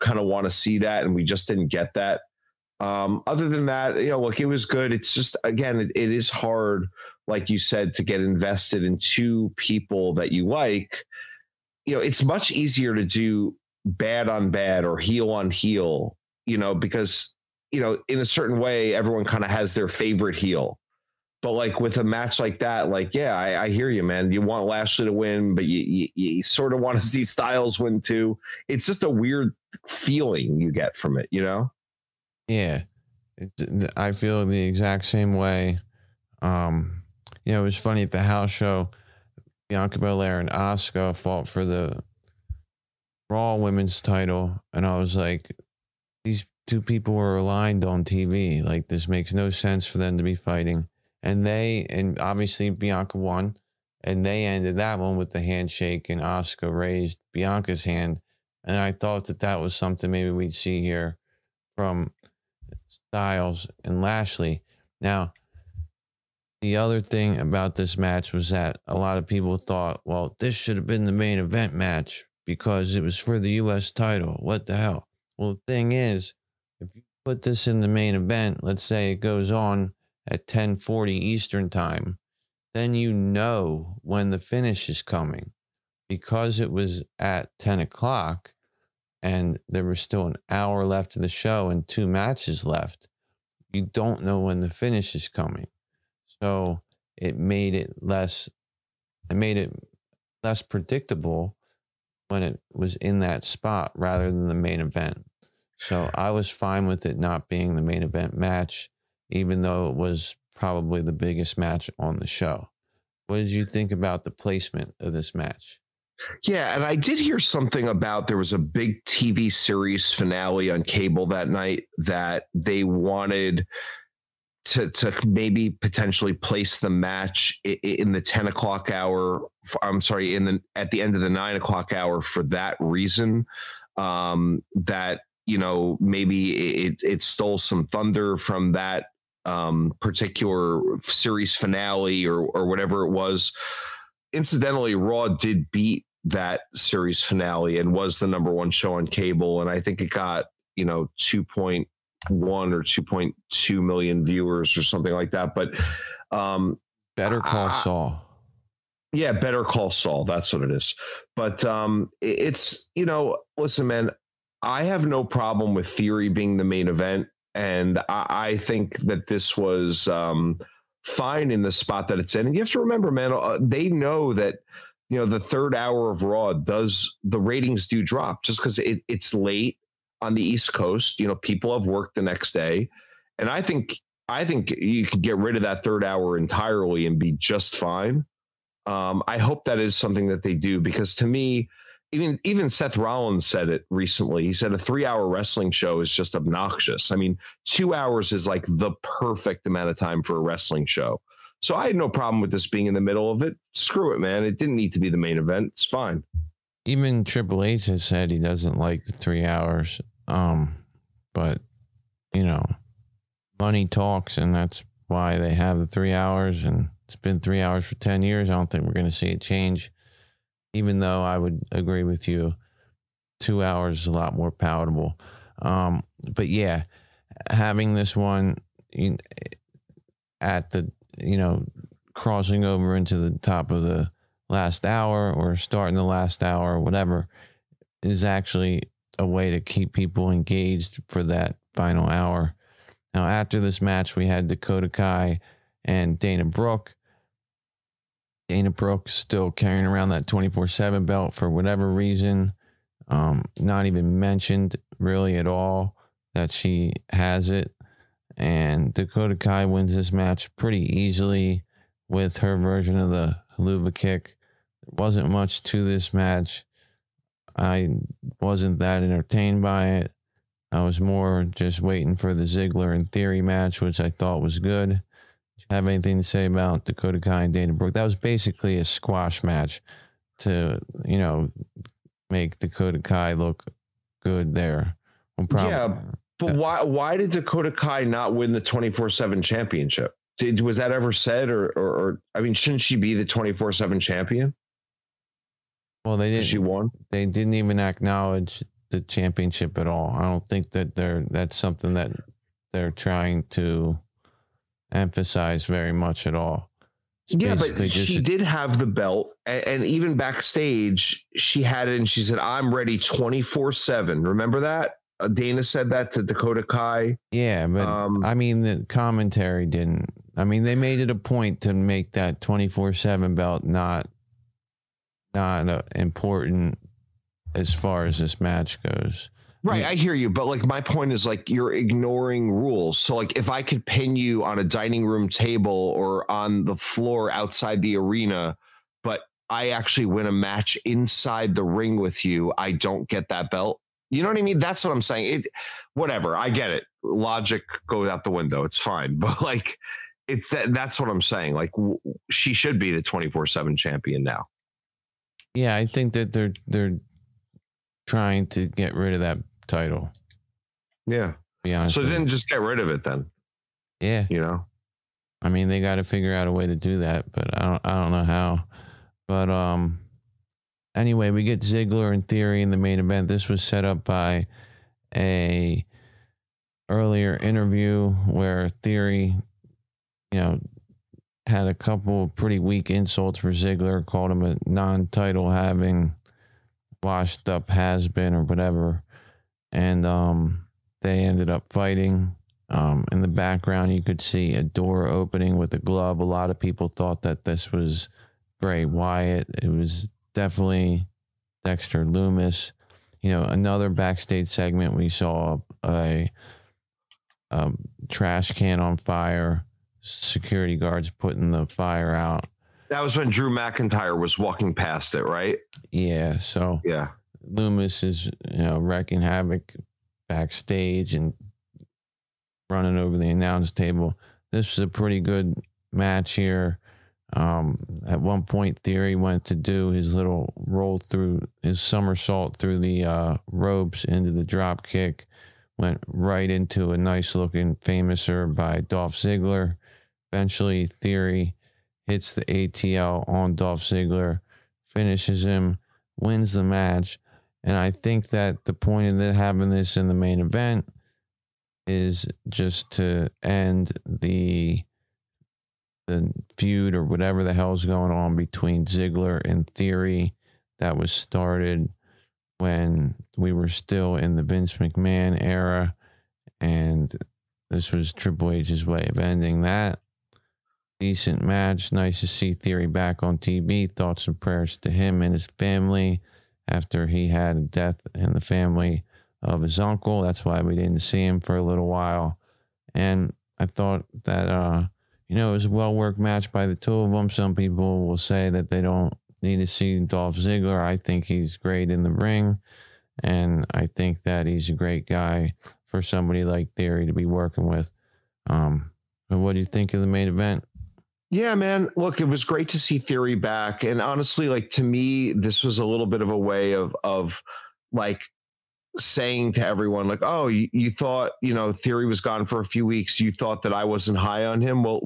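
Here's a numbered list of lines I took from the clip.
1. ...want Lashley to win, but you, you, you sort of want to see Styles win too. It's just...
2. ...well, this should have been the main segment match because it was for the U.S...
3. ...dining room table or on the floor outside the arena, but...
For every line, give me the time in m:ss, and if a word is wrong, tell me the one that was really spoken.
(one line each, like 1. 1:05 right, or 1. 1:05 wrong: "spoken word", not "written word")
1. 0:24 right
2. 1:10 wrong: "event", not "segment"
3. 5:34 right.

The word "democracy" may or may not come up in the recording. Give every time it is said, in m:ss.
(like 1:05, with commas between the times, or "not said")
not said.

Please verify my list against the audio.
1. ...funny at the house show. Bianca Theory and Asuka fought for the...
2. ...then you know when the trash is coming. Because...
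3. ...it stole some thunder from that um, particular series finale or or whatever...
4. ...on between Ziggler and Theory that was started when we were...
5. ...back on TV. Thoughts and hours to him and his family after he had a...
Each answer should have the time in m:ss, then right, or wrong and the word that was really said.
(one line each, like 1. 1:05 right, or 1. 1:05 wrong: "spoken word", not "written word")
1. 0:37 wrong: "Belair", not "Theory"
2. 1:22 wrong: "finish", not "trash"
3. 2:17 right
4. 7:38 right
5. 7:52 wrong: "prayers", not "hours".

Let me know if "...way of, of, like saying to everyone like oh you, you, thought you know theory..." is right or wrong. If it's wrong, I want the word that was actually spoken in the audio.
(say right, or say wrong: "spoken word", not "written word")
right.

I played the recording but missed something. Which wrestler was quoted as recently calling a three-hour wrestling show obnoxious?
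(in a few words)
Seth Rollins.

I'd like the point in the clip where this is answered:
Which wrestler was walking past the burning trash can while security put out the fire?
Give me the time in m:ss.
6:53.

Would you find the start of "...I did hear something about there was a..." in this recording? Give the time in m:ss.
1:56.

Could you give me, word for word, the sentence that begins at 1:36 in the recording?
So it made it less, it made it less predictable when it was in that spot rather than the main event.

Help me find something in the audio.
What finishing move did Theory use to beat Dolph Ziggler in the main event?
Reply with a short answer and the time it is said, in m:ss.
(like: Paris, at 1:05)
ATL, at 7:22.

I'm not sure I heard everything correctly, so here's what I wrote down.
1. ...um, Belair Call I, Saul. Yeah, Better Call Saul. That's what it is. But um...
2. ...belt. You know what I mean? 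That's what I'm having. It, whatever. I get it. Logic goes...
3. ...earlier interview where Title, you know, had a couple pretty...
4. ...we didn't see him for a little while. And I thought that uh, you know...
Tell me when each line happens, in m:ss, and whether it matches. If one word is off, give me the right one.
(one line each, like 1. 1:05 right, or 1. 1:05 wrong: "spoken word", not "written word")
1. 2:36 wrong: "Better", not "Belair"
2. 5:43 wrong: "saying", not "having"
3. 6:16 wrong: "Theory", not "Title"
4. 8:00 right.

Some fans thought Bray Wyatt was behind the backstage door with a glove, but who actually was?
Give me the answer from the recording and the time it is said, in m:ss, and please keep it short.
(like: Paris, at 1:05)
Dexter Lumis, at 6:41.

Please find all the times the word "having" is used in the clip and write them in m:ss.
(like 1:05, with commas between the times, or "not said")
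3:47, 6:25, 7:29.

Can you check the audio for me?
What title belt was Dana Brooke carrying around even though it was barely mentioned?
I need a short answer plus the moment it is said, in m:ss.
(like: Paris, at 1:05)
24/7 title, at 4:10.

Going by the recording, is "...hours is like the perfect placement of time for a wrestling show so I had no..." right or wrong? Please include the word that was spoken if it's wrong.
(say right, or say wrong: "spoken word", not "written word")
wrong: "amount", not "placement".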